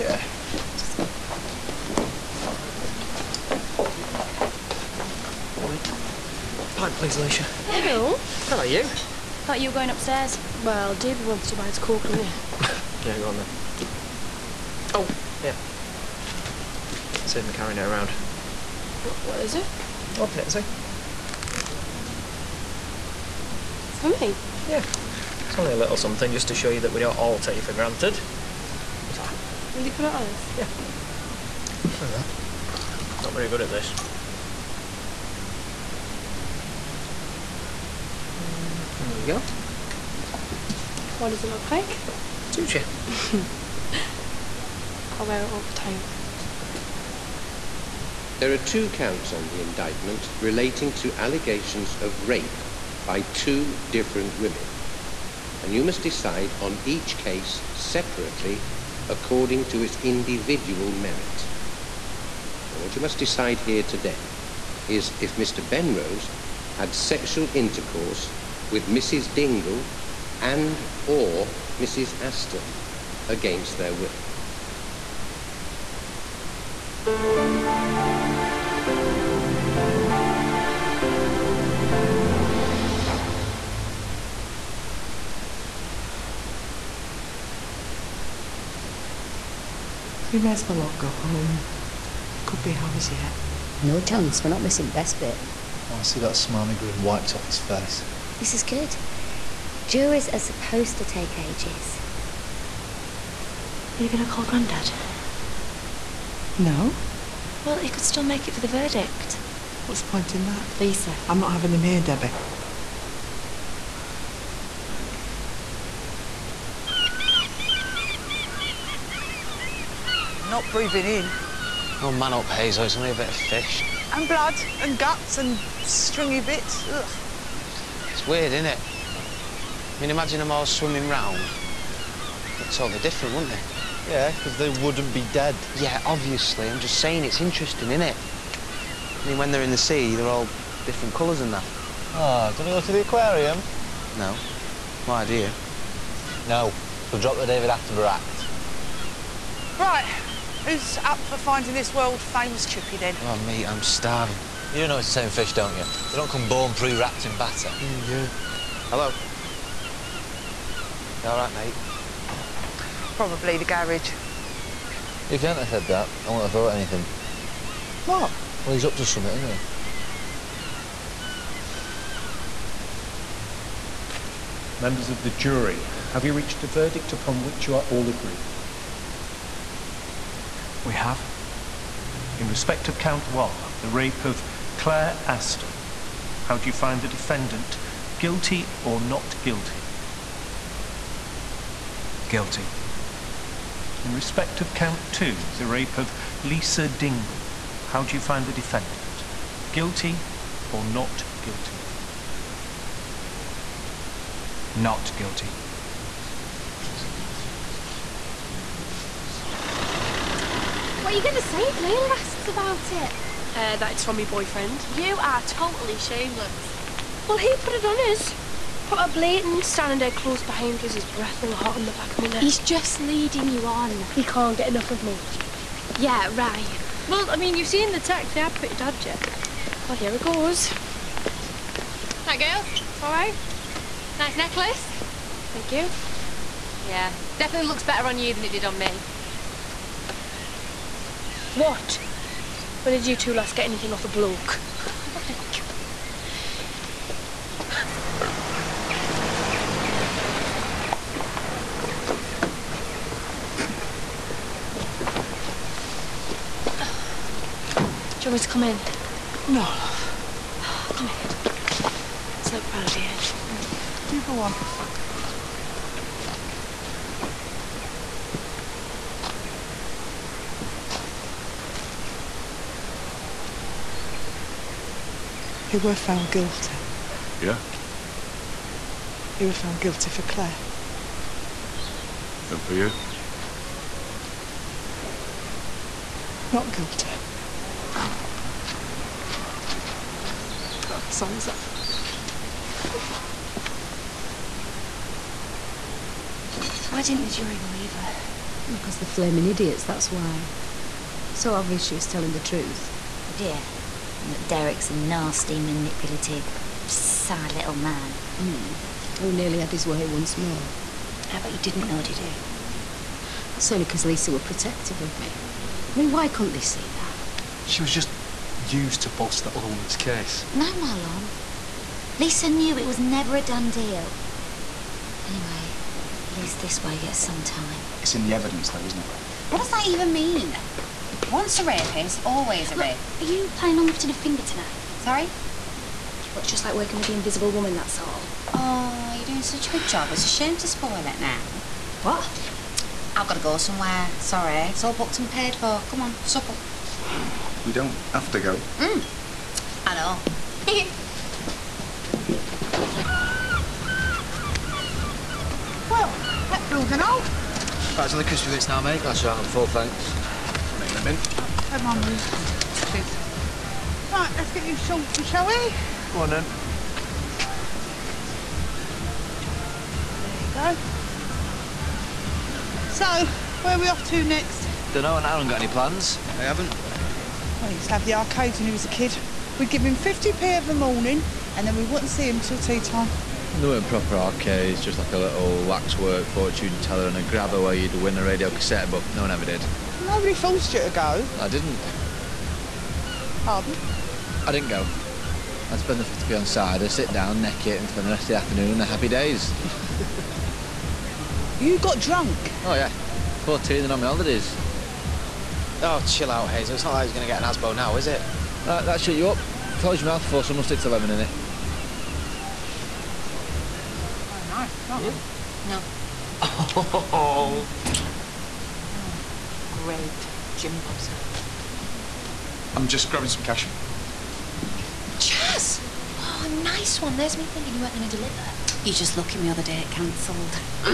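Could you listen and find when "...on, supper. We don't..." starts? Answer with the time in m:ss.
5:46.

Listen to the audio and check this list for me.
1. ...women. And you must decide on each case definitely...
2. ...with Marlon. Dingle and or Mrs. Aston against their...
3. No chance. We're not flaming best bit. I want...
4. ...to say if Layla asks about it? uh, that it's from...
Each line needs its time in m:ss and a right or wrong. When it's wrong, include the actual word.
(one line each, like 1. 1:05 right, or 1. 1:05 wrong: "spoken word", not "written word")
1. 0:54 wrong: "separately", not "definitely"
2. 1:08 wrong: "Mrs", not "Marlon"
3. 1:33 wrong: "missing", not "flaming"
4. 3:31 right.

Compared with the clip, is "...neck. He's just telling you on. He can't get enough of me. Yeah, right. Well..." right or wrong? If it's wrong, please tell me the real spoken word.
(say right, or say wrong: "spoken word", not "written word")
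wrong: "leading", not "telling".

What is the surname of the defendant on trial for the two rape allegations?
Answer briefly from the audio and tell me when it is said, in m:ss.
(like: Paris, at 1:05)
Benrose, at 1:05.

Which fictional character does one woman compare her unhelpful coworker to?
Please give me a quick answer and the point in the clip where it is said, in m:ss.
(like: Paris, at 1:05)
the Invisible Woman, at 5:37.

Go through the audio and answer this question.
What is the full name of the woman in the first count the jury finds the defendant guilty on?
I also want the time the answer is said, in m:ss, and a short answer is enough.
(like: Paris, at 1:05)
Claire Aston, at 3:04.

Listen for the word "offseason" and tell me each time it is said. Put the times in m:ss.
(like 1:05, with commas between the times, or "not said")
not said.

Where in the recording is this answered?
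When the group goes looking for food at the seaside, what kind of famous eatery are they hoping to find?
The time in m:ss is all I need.
2:32.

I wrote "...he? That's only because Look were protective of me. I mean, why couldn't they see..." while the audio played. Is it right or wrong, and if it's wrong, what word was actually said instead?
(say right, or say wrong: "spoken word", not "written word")
wrong: "Lisa", not "Look".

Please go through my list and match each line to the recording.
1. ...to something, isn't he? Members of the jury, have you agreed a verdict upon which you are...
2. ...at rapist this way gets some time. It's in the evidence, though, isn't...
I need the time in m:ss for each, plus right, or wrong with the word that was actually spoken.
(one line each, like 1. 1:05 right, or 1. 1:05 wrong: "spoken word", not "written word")
1. 2:48 wrong: "reached", not "agreed"
2. 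5:26 wrong: "least", not "rapist".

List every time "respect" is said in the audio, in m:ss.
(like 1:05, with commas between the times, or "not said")
3:02, 3:14.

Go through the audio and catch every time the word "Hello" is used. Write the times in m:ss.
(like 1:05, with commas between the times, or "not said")
0:07, 2:38.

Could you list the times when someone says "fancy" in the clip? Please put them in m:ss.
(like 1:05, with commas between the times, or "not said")
not said.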